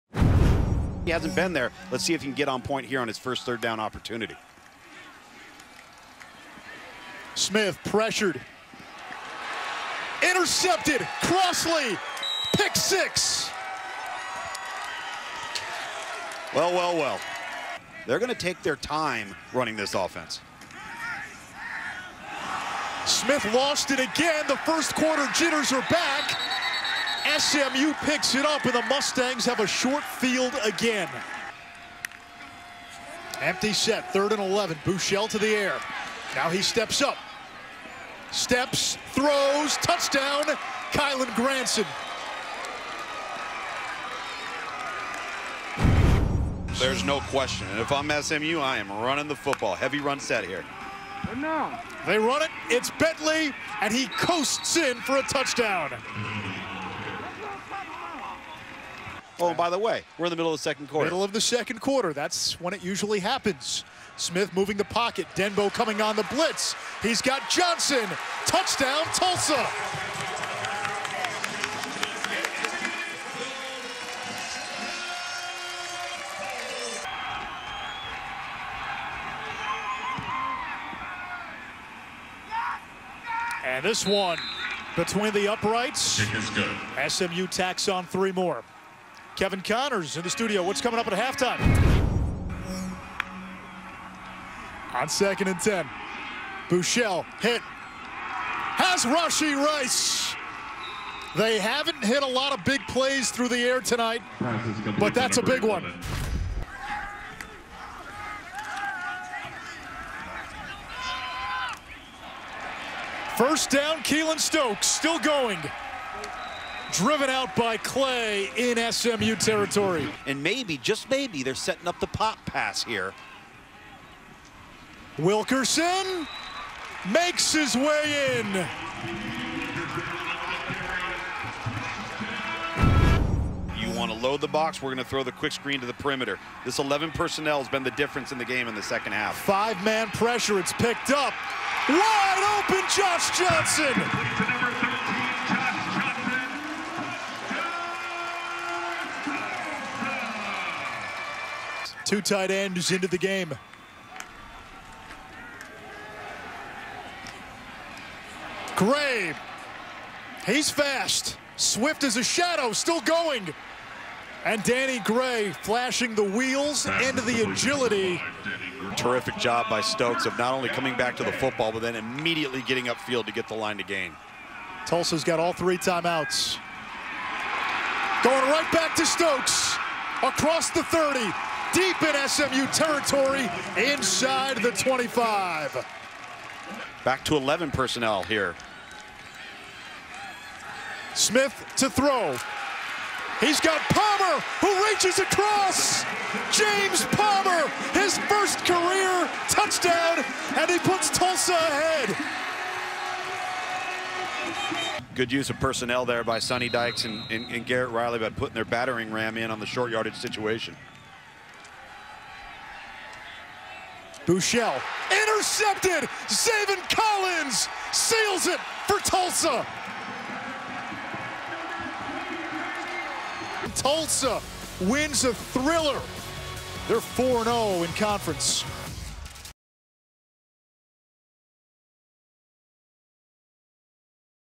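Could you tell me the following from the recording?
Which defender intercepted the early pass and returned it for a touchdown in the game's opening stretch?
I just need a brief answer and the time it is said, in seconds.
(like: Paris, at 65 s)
Crossley, at 11 s.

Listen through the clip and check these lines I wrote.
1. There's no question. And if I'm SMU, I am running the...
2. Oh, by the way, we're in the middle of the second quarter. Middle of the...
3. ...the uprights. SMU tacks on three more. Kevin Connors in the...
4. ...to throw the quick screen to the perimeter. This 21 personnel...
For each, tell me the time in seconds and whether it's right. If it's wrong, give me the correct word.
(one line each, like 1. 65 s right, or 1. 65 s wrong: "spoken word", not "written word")
1. 46 s right
2. 59 s right
3. 85 s right
4. 135 s wrong: "11", not "21".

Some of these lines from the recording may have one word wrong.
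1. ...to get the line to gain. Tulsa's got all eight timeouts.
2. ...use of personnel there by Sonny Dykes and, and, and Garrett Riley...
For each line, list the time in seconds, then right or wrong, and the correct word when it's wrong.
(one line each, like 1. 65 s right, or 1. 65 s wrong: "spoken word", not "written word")
1. 173 s wrong: "three", not "eight"
2. 205 s right.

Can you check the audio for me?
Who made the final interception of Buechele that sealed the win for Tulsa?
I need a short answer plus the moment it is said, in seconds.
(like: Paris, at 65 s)
Zaven Collins, at 216 s.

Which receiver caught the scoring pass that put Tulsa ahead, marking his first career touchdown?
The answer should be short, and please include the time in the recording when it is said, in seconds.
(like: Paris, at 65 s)
James Palmer, at 196 s.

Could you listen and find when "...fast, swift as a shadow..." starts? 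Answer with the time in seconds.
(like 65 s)
160 s.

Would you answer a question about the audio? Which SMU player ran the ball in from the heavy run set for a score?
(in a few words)
Bentley.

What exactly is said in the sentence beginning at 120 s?
And maybe, just maybe, they're setting up the pop pass here.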